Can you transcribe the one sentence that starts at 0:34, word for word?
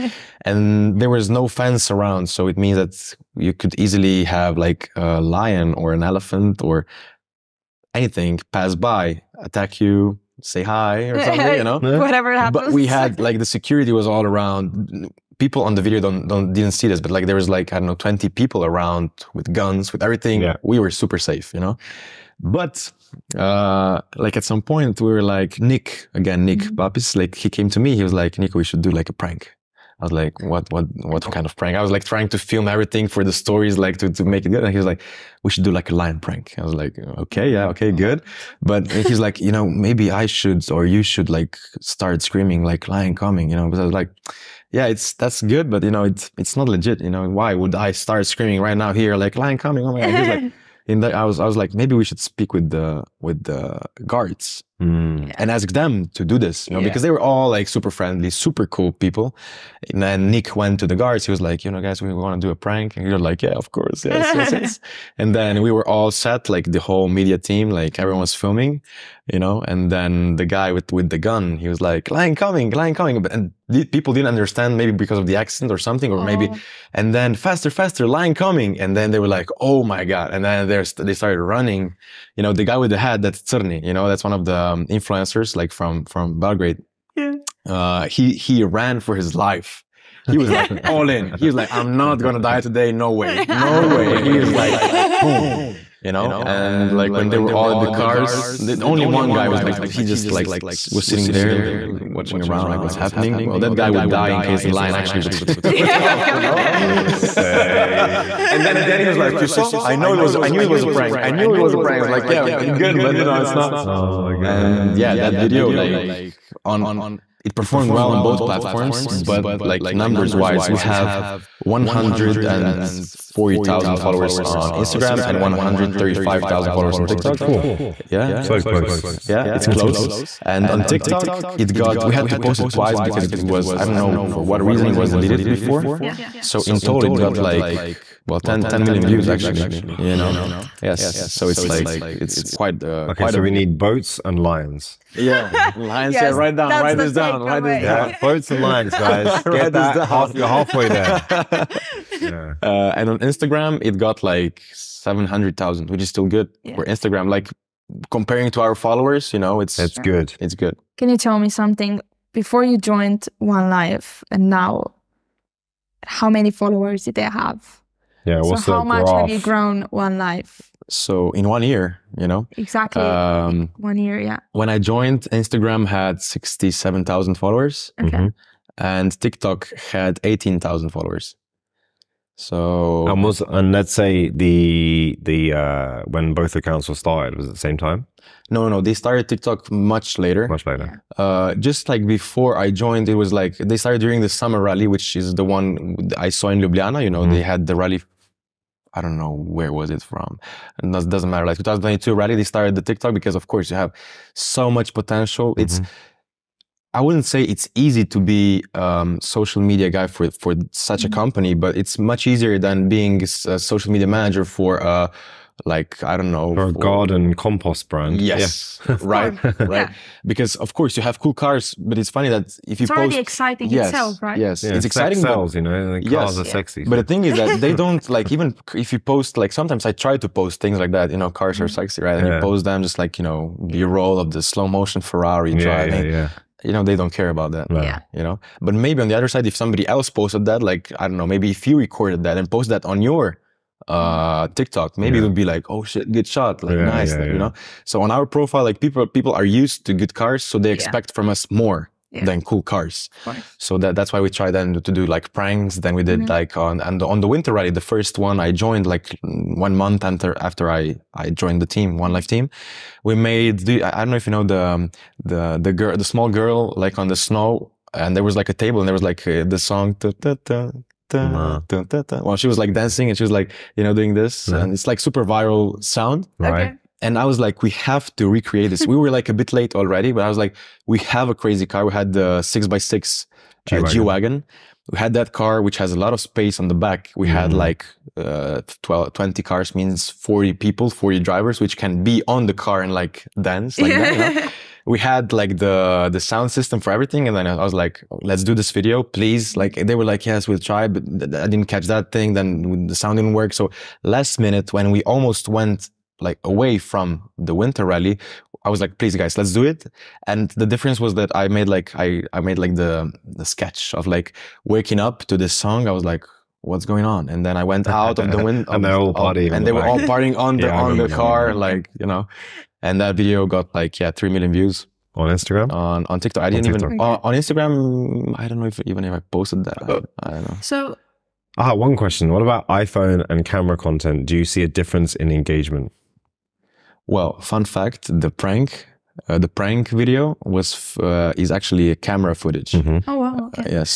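And he was like, we should do like a lion prank.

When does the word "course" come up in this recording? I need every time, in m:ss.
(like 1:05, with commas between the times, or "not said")
1:03, 3:23, 3:40.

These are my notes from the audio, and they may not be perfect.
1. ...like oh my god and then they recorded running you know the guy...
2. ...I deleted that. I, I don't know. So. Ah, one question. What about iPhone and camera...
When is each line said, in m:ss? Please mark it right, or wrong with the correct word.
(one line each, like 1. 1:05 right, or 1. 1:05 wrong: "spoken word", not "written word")
1. 1:19 wrong: "started", not "recorded"
2. 5:29 wrong: "posted", not "deleted".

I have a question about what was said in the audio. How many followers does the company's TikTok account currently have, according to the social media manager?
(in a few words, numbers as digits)
135,000.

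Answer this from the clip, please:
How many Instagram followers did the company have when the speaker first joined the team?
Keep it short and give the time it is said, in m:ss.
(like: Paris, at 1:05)
67,000, at 2:56.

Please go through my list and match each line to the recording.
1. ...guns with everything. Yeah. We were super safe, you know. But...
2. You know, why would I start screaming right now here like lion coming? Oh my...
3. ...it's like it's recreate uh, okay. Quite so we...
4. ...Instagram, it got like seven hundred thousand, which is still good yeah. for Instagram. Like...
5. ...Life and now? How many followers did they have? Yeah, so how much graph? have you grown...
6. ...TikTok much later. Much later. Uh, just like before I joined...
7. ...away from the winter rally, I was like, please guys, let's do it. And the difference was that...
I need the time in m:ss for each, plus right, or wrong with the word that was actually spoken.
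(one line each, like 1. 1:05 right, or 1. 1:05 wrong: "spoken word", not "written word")
1. 0:19 right
2. 0:47 right
3. 2:21 wrong: "quite", not "recreate"
4. 2:33 right
5. 2:43 right
6. 3:09 right
7. 5:06 right.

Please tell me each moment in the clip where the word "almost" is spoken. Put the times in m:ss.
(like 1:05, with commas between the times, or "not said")
3:03, 5:05.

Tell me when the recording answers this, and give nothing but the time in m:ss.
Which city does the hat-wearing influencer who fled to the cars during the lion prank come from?
1:26.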